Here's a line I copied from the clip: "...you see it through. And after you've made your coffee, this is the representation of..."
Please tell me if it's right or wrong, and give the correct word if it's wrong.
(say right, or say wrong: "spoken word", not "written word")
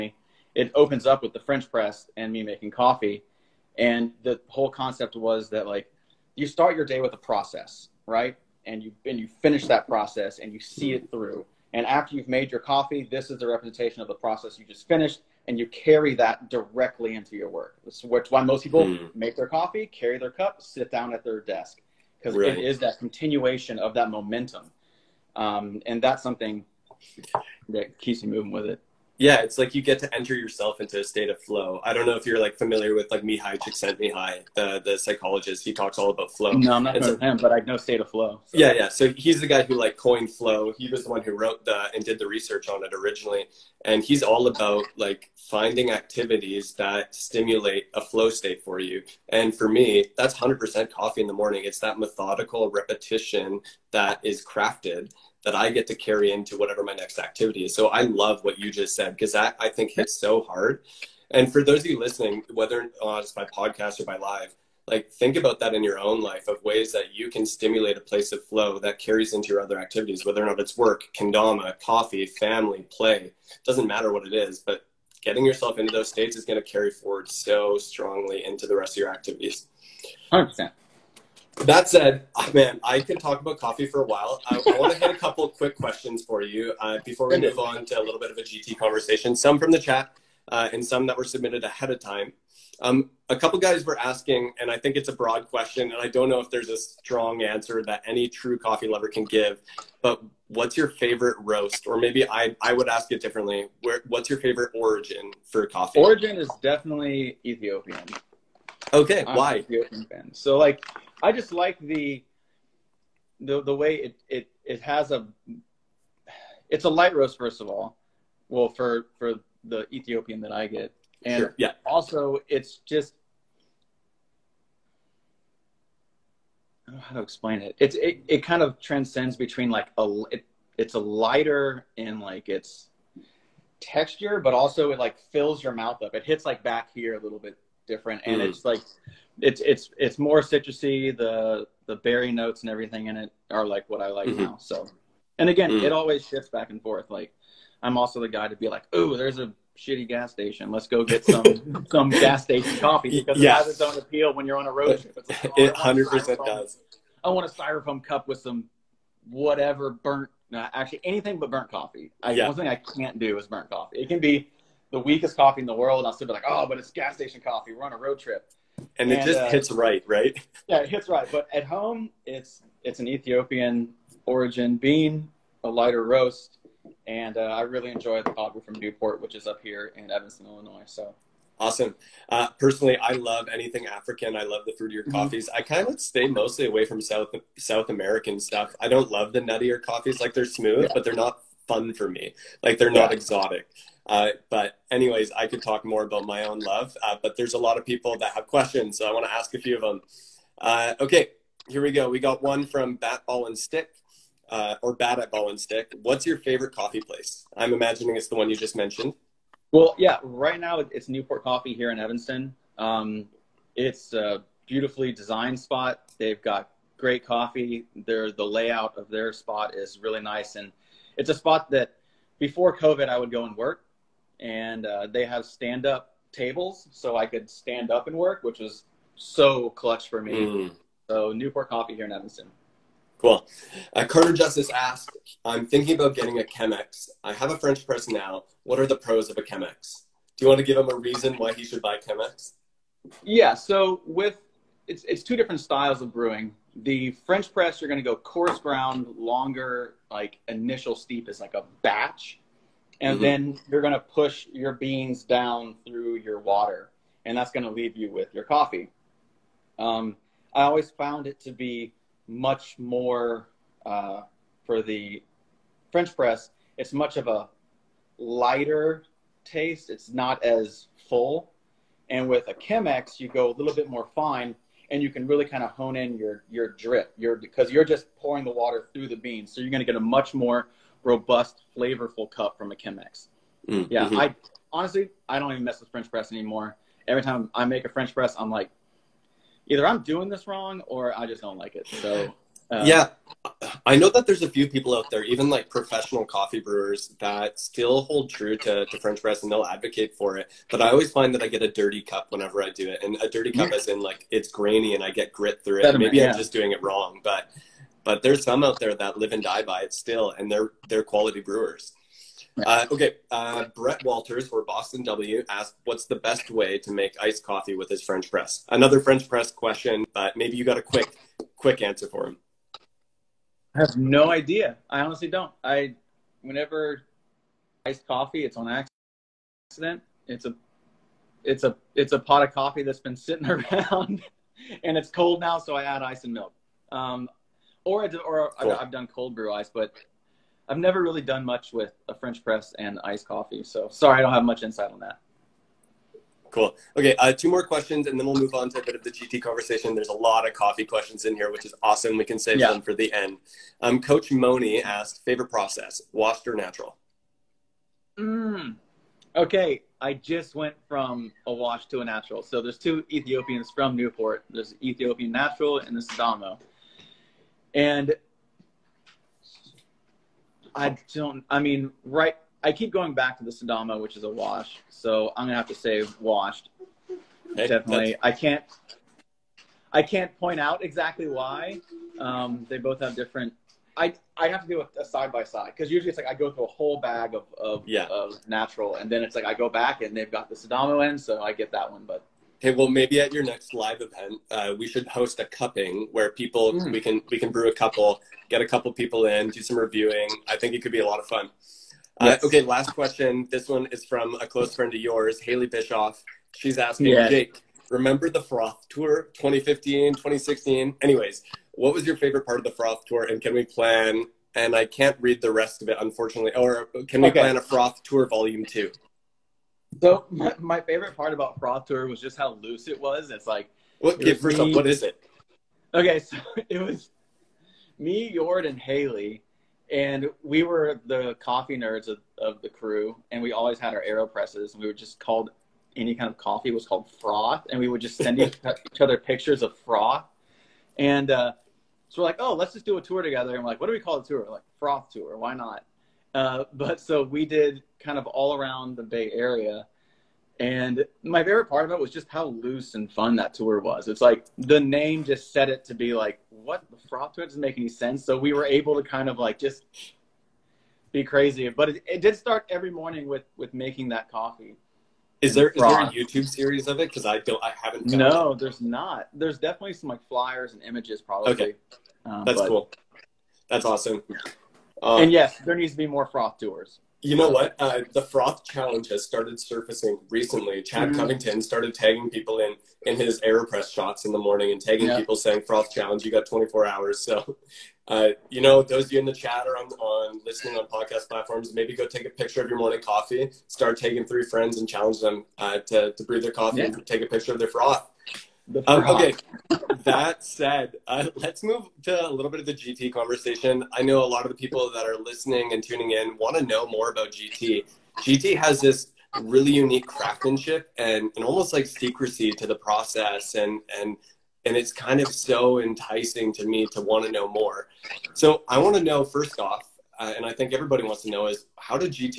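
right.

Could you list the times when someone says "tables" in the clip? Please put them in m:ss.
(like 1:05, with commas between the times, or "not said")
3:46.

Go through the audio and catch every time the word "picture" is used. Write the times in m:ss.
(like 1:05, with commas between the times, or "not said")
7:19, 8:12, 8:17.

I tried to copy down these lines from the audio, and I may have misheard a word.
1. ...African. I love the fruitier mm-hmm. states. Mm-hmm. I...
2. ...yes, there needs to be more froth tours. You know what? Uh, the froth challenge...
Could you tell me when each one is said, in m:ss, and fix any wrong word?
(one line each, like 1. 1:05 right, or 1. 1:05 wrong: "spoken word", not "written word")
1. 3:03 wrong: "coffees", not "states"
2. 7:55 right.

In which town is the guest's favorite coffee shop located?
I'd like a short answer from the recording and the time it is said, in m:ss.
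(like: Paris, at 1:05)
Evanston, Illinois, at 3:00.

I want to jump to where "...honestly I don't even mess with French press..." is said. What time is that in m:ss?
4:44.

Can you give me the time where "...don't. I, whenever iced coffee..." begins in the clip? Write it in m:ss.
5:25.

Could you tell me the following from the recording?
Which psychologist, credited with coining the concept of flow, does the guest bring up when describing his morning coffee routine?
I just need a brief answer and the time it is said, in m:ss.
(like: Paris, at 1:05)
Mihai Csikszentmihalyi, at 0:33.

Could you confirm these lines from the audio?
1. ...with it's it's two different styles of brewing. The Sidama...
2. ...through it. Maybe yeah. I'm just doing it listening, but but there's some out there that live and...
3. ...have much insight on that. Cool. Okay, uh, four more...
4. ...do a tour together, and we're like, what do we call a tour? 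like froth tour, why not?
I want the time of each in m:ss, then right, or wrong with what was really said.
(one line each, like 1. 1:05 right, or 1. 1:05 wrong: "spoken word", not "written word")
1. 4:04 wrong: "French", not "Sidama"
2. 5:05 wrong: "wrong", not "listening"
3. 5:44 wrong: "two", not "four"
4. 7:22 right.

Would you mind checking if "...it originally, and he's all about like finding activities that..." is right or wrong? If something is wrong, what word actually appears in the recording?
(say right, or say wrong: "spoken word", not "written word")
right.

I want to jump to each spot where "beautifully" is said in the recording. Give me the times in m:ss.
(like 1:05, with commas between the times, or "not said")
3:34.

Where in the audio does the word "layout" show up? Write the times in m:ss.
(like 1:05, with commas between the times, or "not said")
3:38.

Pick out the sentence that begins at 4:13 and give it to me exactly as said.
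then you're going to push your beans down through your water, and that's going to leave you with your coffee.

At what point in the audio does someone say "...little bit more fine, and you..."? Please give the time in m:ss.
4:33.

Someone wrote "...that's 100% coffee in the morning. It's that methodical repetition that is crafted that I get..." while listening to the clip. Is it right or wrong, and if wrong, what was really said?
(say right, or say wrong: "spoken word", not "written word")
right.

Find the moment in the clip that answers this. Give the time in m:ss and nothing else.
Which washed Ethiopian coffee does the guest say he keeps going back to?
6:13.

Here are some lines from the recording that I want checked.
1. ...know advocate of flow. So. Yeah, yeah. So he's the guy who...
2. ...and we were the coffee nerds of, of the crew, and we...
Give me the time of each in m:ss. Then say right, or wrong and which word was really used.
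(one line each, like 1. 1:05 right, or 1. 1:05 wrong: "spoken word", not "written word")
1. 0:37 wrong: "state", not "advocate"
2. 7:09 right.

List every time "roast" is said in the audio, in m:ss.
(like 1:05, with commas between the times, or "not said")
1:41, 1:57, 2:56.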